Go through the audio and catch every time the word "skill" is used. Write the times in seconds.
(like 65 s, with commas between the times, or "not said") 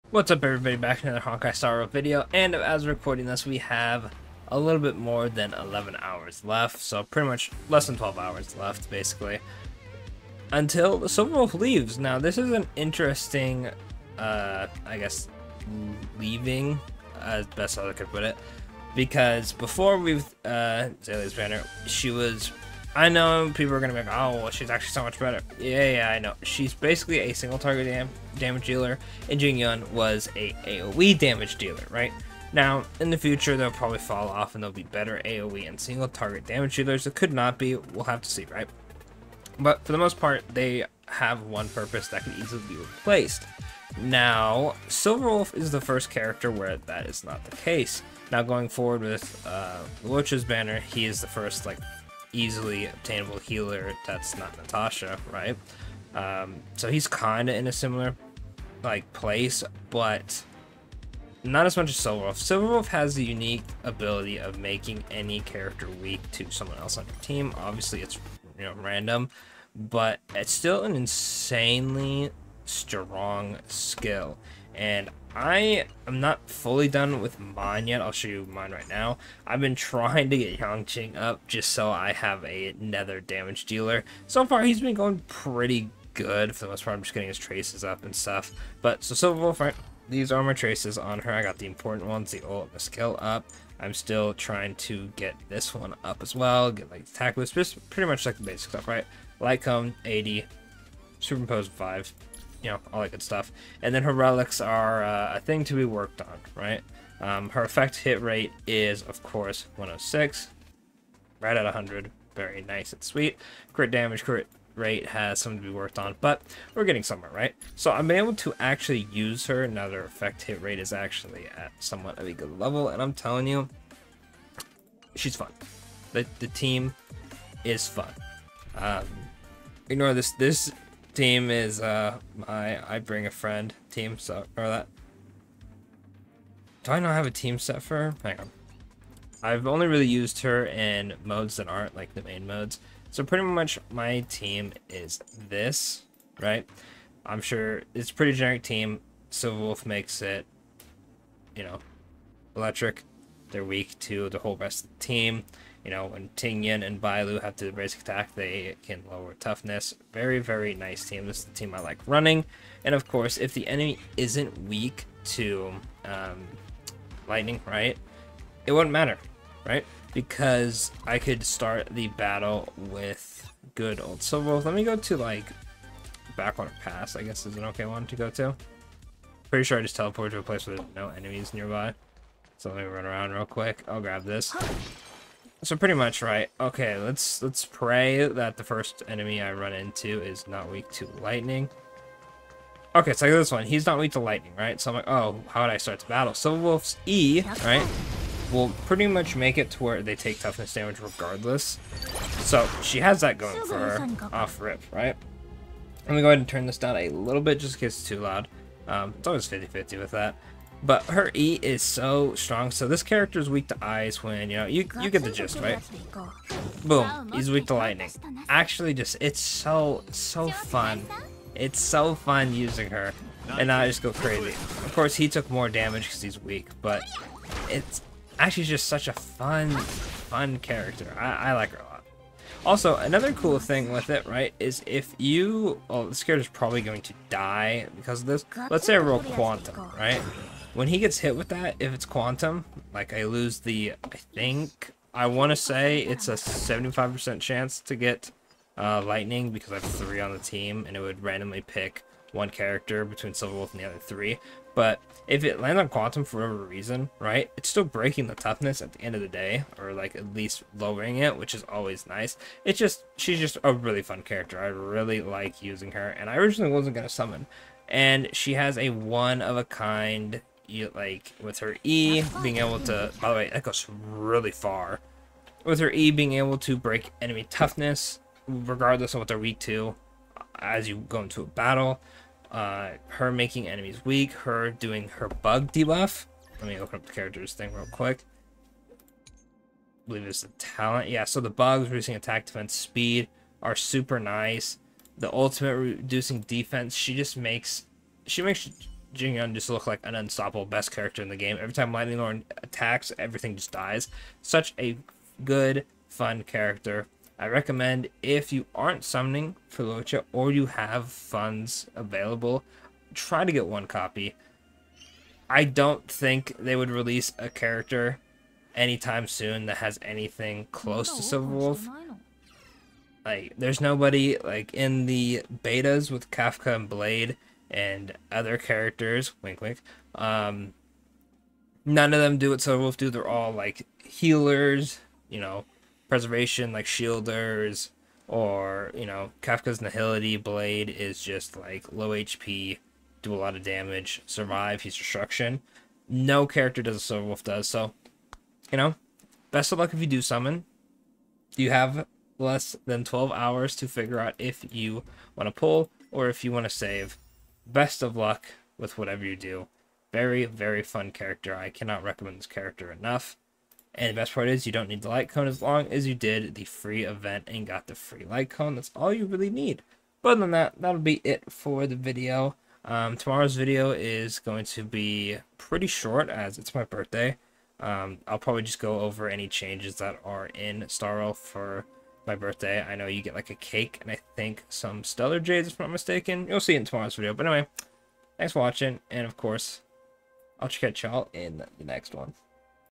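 73 s, 92 s.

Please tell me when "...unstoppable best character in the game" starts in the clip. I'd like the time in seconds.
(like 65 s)
300 s.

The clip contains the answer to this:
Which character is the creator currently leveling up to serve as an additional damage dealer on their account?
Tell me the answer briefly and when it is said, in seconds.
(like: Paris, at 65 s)
Yanqing, at 80 s.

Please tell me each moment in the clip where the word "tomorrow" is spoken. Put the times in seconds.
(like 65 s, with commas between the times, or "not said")
373 s, 386 s.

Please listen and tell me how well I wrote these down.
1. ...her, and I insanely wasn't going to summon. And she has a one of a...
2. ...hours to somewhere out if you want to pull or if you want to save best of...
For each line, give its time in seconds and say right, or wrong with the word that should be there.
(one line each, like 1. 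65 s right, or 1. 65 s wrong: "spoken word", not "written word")
1. 265 s wrong: "originally", not "insanely"
2. 353 s wrong: "figure", not "somewhere".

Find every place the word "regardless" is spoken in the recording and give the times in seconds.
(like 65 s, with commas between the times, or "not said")
200 s, 278 s.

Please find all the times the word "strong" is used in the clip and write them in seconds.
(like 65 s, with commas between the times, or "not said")
72 s, 212 s.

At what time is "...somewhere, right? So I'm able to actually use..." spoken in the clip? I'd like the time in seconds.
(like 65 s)
117 s.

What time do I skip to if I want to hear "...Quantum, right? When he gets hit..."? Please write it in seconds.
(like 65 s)
239 s.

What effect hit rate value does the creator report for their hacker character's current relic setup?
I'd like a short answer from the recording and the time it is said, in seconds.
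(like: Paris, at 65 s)
106, at 109 s.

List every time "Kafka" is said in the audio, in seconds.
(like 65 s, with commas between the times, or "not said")
326 s, 339 s.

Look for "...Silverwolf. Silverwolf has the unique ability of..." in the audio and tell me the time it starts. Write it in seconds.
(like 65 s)
61 s.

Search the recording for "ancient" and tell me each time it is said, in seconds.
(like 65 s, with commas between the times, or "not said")
not said.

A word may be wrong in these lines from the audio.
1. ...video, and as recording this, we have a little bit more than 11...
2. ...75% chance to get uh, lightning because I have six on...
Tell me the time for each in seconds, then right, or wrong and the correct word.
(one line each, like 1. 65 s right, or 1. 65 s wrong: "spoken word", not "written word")
1. 1 s right
2. 246 s wrong: "three", not "six".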